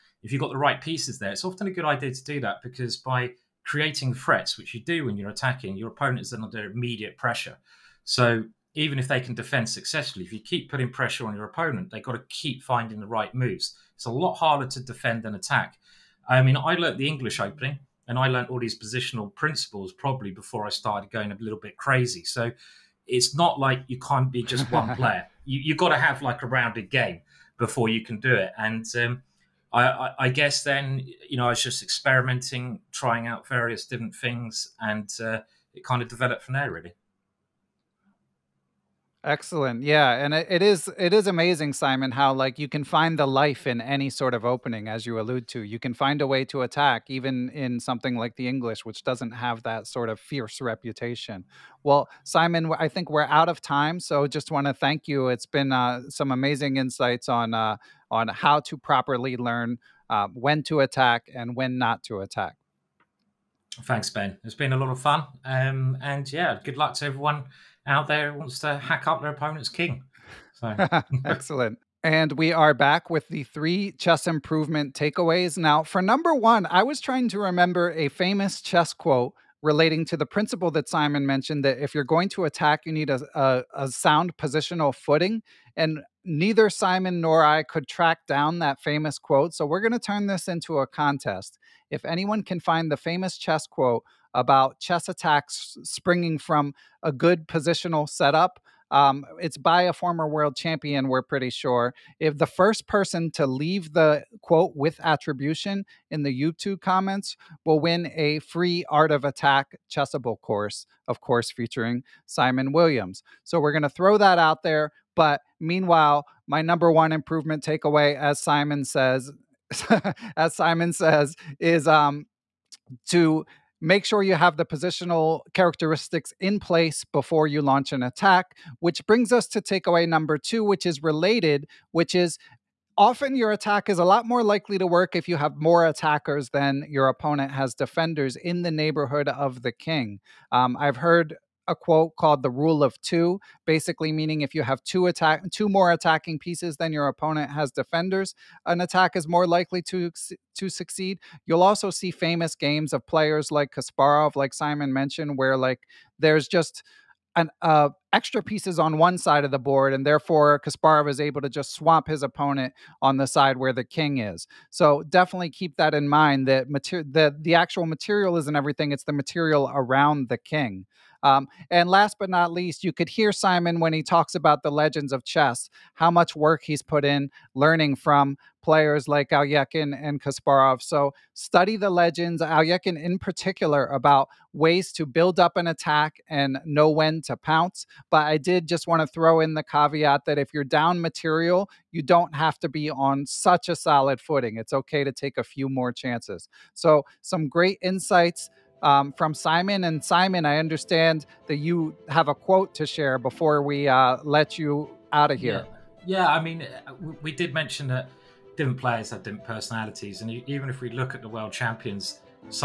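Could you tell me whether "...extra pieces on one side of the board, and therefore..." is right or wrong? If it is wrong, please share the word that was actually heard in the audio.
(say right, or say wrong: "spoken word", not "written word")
right.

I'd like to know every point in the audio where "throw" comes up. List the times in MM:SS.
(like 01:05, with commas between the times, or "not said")
01:53, 03:09.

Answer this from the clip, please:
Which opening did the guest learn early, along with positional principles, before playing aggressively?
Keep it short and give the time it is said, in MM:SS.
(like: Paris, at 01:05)
English opening, at 00:17.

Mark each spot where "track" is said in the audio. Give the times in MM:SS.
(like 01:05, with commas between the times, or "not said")
01:27.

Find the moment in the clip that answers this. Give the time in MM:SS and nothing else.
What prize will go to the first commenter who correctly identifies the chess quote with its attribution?
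01:48.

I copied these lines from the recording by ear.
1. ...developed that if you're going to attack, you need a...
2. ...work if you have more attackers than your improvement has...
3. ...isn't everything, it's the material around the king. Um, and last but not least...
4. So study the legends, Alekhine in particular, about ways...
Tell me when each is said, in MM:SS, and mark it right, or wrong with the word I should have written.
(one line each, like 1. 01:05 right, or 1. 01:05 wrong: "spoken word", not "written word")
1. 01:21 wrong: "mentioned", not "developed"
2. 02:14 wrong: "opponent", not "improvement"
3. 02:48 right
4. 03:00 right.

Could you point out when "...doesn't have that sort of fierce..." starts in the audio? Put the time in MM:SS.
00:49.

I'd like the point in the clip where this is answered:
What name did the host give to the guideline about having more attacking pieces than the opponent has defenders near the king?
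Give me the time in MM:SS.
02:22.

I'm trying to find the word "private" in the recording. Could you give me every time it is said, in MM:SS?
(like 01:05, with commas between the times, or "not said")
not said.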